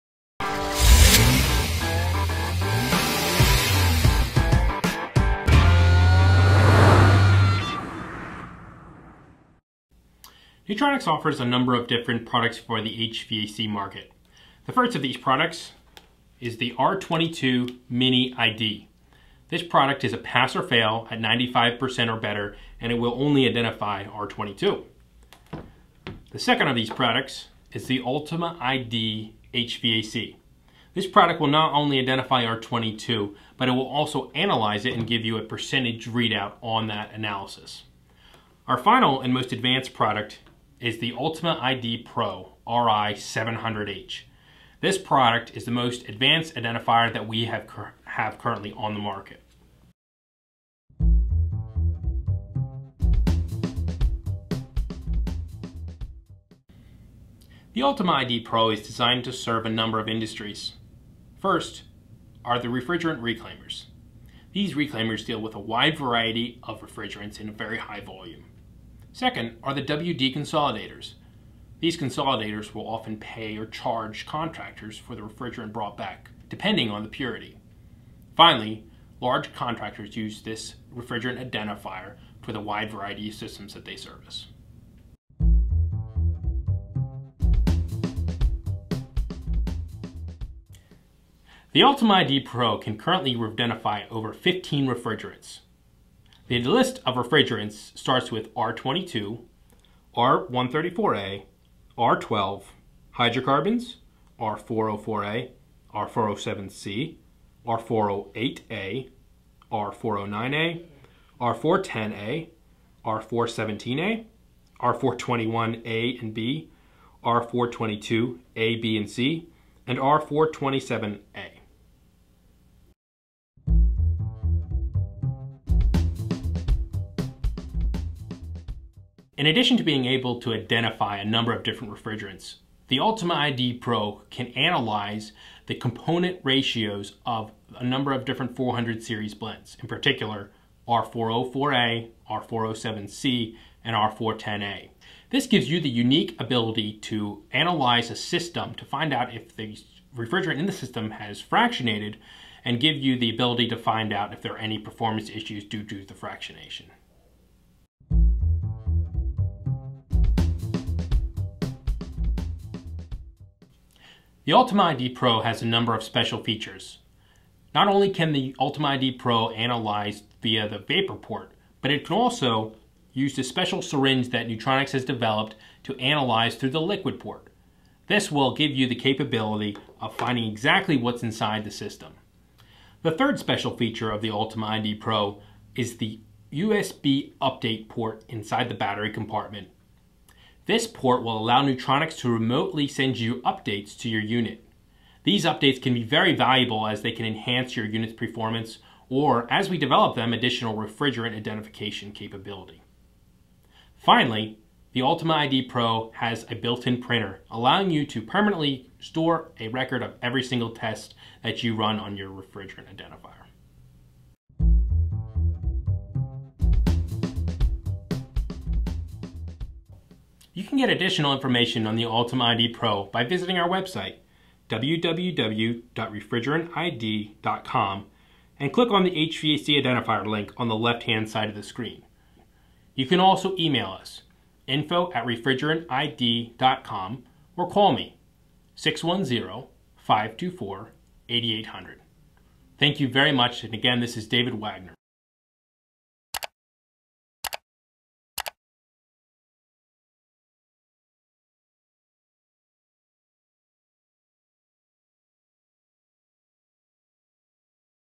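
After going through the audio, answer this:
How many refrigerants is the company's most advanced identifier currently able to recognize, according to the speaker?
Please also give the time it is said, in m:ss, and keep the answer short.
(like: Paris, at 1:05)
over 15, at 1:34.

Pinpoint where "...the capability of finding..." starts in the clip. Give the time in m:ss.
2:58.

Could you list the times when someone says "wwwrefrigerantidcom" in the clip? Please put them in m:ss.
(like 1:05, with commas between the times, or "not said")
3:44.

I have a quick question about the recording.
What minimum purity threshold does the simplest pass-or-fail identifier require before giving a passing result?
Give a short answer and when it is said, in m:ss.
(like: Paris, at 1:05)
95%, at 0:21.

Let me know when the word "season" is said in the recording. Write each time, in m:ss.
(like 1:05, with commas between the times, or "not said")
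not said.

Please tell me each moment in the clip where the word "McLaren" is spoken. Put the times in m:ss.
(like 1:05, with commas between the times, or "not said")
not said.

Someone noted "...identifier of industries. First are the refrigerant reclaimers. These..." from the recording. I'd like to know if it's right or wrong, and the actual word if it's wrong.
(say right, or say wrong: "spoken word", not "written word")
wrong: "number", not "identifier".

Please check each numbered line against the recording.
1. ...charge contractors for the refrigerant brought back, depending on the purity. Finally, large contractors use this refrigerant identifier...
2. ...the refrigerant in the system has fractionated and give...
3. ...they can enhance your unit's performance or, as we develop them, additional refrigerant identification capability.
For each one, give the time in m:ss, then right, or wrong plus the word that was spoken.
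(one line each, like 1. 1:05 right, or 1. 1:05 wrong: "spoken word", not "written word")
1. 1:13 right
2. 2:29 right
3. 3:17 right.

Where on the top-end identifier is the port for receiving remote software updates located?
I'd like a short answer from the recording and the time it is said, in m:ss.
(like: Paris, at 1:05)
inside the battery compartment, at 3:08.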